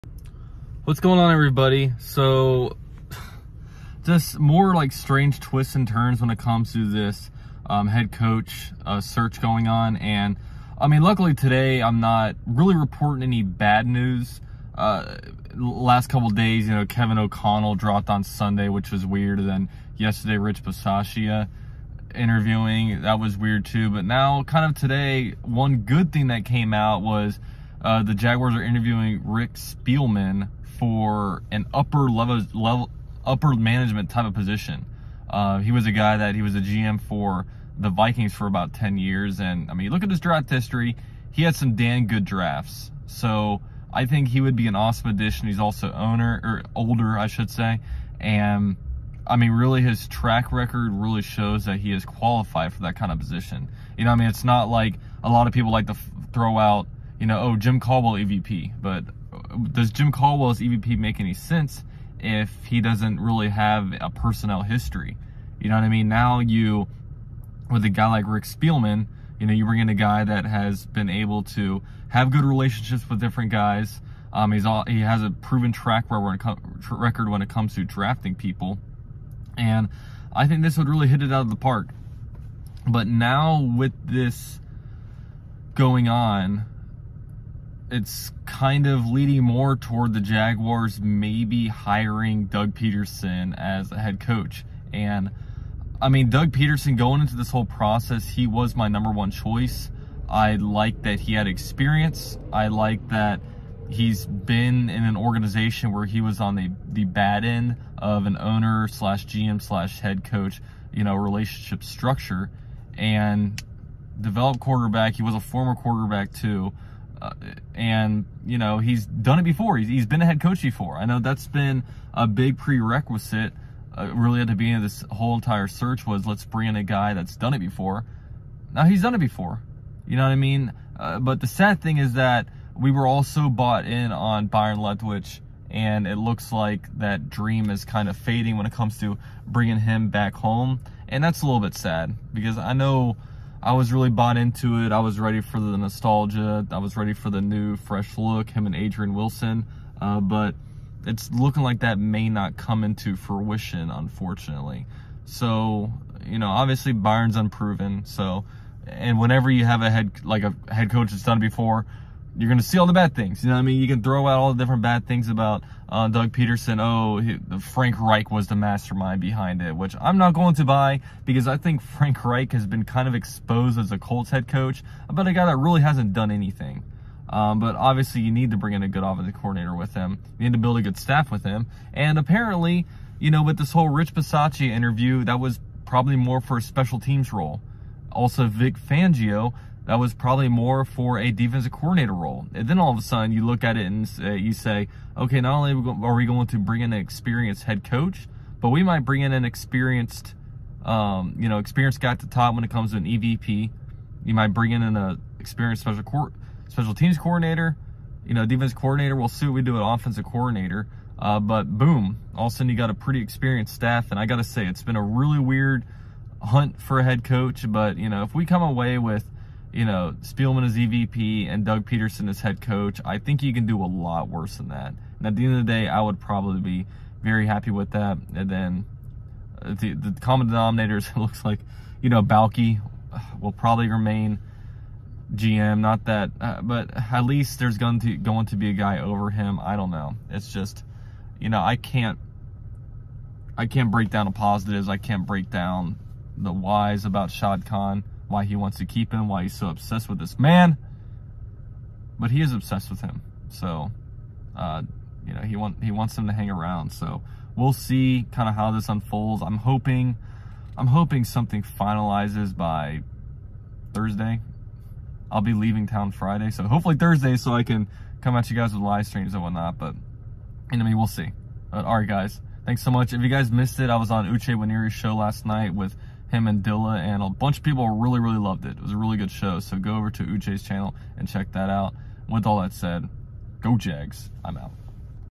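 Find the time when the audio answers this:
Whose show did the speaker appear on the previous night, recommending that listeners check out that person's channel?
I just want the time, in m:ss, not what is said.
4:34.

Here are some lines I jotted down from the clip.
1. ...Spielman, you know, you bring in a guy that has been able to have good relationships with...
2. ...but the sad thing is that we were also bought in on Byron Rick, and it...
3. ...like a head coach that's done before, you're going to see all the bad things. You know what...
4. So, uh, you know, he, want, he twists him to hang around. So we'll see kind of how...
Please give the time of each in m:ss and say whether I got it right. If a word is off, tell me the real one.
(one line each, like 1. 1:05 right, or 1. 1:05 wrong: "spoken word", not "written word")
1. 1:08 right
2. 2:11 wrong: "Leftwich", not "Rick"
3. 2:40 right
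4. 4:13 wrong: "wants", not "twists".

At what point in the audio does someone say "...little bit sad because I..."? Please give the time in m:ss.
2:21.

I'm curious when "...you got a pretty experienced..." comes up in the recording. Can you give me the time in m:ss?
3:32.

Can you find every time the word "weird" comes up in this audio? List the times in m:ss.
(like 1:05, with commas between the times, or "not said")
0:19, 0:23, 3:35.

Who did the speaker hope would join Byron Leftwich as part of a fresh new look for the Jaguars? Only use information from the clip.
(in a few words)
Adrian Wilson.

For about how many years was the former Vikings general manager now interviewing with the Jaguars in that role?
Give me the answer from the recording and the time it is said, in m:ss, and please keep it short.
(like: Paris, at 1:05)
10, at 0:38.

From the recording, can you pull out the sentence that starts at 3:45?
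And at the end of the day, I would probably be very happy with that.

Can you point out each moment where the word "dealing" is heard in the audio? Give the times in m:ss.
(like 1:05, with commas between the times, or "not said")
not said.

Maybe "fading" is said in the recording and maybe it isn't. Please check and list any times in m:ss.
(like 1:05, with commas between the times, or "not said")
2:18.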